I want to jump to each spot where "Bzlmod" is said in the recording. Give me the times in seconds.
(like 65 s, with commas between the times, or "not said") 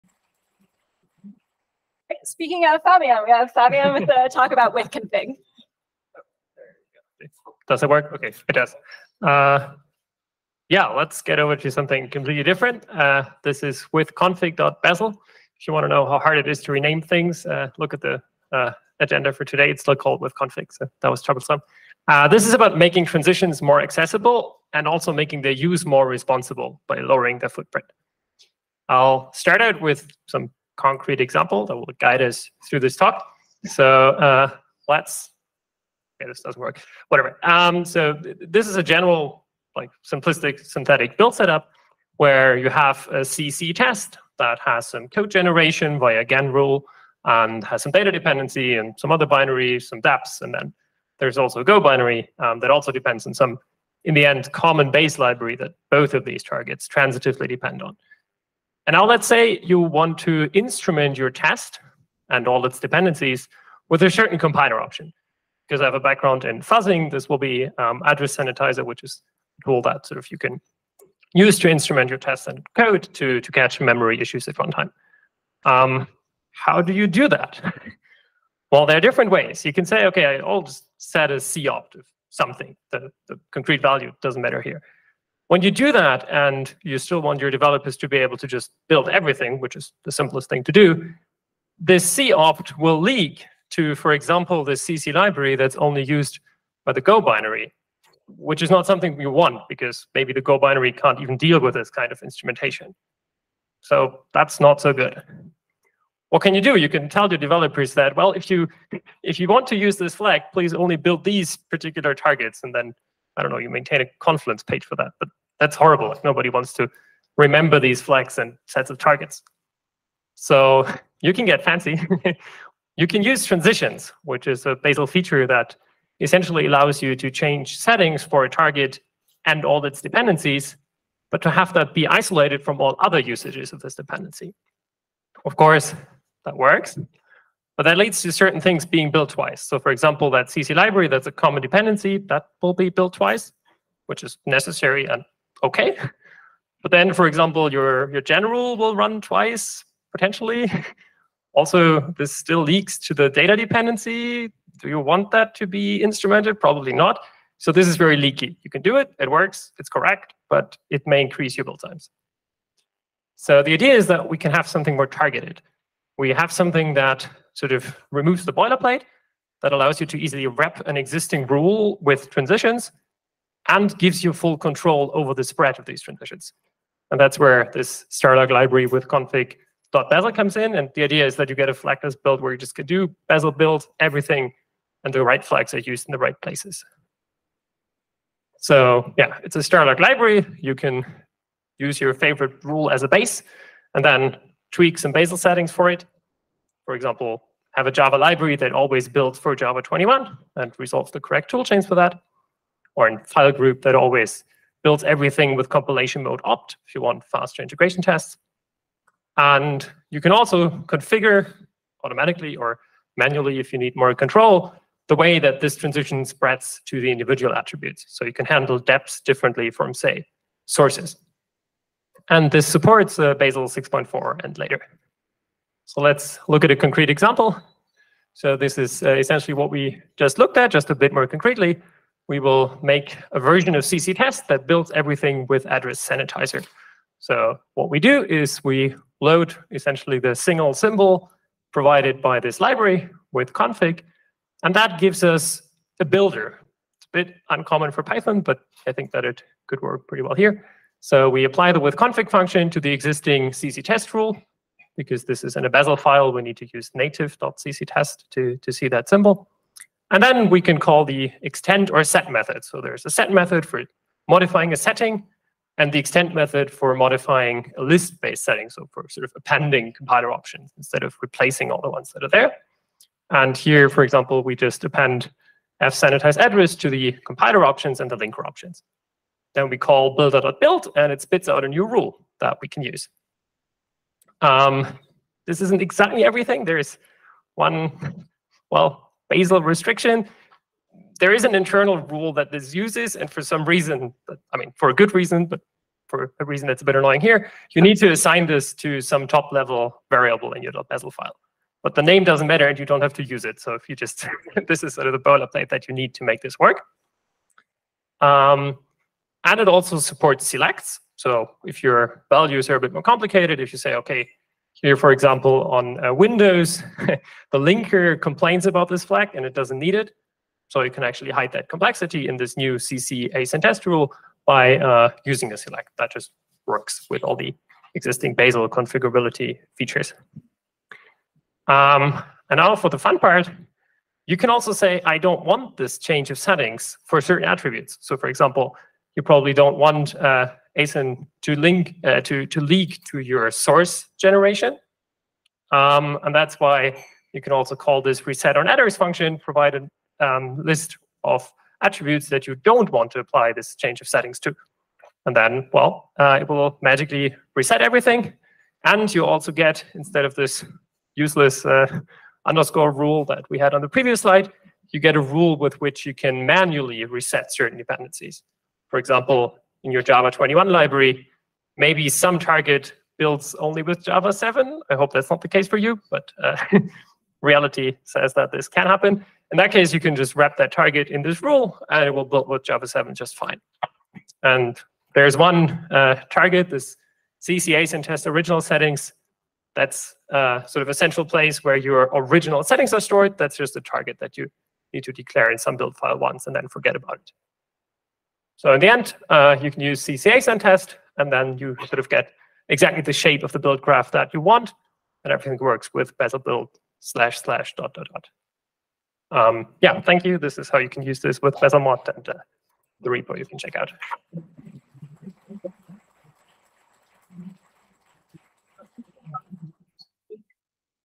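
411 s.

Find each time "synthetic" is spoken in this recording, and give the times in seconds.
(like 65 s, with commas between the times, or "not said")
40 s.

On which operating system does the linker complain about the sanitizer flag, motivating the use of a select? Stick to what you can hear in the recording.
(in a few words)
Windows.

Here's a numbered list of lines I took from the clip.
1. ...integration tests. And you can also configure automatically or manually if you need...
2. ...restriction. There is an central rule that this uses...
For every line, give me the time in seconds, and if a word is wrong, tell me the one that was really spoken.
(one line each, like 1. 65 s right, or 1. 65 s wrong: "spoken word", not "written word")
1. 207 s right
2. 289 s wrong: "internal", not "central".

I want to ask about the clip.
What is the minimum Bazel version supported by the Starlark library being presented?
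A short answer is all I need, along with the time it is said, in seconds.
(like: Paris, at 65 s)
6.4, at 223 s.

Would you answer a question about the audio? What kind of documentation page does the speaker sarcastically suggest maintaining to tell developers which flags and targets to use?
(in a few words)
confluence page.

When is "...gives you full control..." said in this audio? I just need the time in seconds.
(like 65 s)
173 s.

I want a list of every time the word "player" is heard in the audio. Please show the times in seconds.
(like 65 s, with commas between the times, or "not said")
not said.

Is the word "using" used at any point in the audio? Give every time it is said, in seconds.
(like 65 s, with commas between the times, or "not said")
325 s.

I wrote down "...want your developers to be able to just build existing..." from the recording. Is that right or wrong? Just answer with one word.
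wrong.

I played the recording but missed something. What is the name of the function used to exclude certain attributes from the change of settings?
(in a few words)
reset_on_attrs.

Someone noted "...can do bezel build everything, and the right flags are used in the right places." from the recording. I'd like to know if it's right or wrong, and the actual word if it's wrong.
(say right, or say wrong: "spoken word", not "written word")
right.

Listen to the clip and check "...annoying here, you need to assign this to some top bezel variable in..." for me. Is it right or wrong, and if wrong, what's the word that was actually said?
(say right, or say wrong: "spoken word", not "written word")
wrong: "level", not "bezel".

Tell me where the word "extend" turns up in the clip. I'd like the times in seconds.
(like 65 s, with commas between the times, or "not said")
261 s, 265 s.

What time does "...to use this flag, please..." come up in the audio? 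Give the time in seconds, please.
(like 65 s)
109 s.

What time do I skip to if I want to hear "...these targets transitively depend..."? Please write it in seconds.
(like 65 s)
56 s.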